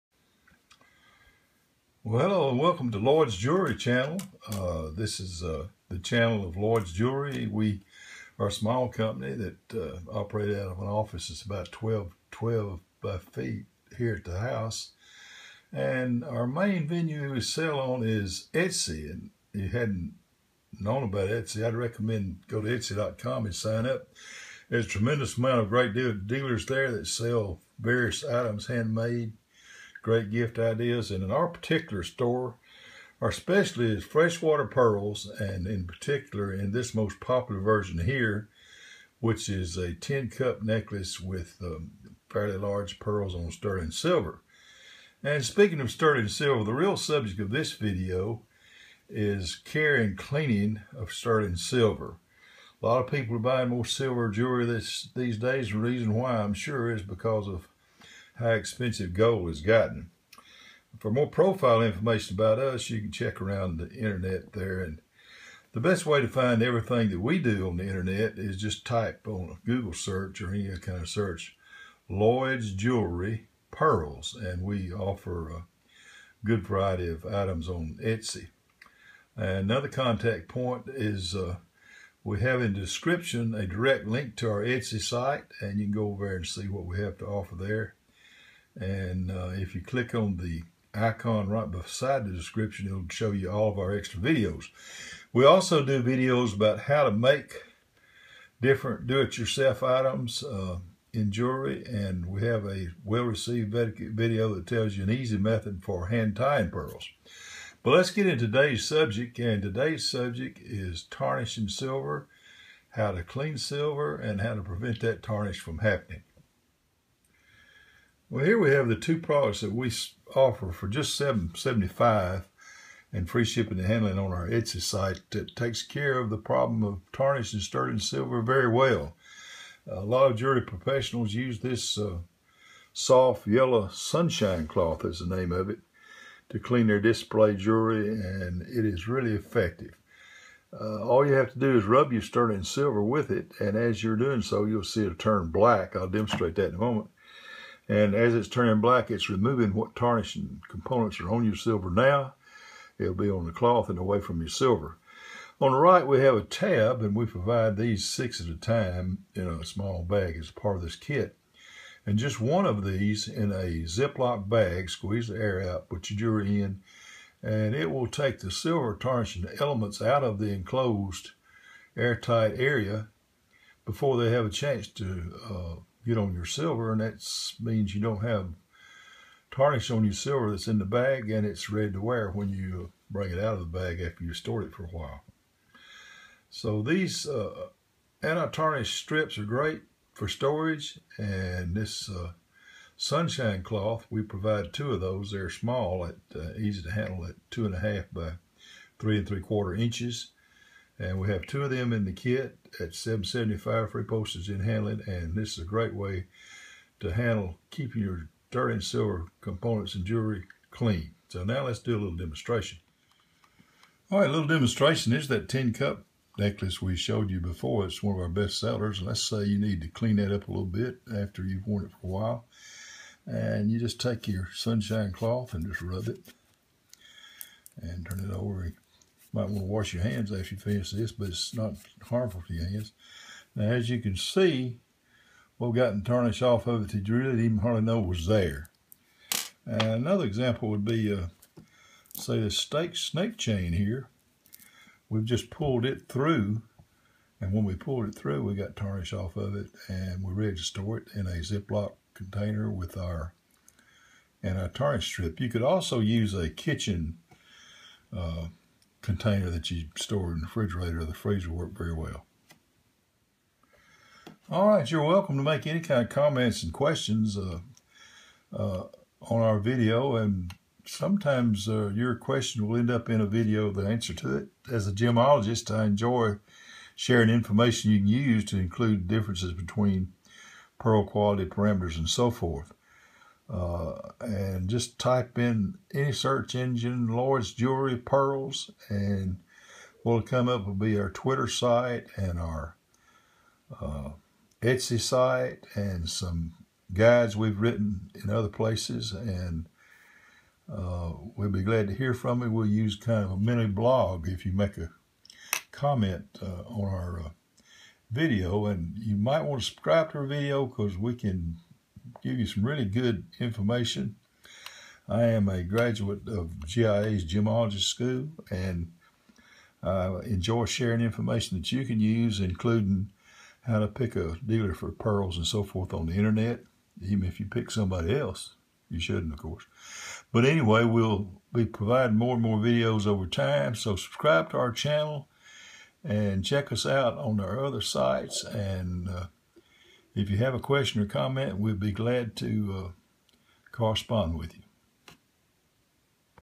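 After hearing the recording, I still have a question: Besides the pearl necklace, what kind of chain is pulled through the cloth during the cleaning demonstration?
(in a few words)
snake chain.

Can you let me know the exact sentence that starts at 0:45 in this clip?
And speaking of sterling silver, the real subject of this video is care and cleaning of sterling silver.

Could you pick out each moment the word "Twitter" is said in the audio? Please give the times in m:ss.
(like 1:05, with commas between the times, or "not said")
4:51.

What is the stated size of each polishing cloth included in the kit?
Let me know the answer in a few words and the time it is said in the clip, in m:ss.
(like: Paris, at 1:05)
2.5 by 3.75 inches, at 3:17.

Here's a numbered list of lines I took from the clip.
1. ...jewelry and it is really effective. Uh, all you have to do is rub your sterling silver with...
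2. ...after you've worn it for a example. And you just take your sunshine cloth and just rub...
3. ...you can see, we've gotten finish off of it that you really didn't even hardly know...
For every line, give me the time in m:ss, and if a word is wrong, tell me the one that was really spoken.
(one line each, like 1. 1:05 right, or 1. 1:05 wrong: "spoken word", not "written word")
1. 2:17 right
2. 3:41 wrong: "while", not "example"
3. 3:53 wrong: "tarnish", not "finish".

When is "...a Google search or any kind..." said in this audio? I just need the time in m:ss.
1:09.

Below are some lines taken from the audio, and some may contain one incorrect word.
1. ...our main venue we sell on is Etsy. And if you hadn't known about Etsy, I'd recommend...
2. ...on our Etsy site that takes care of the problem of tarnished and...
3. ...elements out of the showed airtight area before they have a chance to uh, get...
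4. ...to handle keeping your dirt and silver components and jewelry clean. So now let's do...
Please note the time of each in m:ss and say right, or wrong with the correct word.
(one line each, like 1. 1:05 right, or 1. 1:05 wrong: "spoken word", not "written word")
1. 0:16 right
2. 2:04 right
3. 2:49 wrong: "enclosed", not "showed"
4. 3:26 right.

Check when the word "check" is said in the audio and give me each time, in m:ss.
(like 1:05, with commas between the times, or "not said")
1:03, 5:36.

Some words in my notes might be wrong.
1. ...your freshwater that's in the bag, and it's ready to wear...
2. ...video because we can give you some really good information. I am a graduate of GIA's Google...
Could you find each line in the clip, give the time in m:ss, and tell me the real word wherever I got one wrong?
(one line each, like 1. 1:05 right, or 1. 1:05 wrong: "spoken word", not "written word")
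1. 3:00 wrong: "silver", not "freshwater"
2. 5:10 wrong: "Gemology", not "Google".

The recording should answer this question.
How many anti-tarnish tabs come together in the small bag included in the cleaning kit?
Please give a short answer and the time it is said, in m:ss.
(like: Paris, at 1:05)
6, at 2:38.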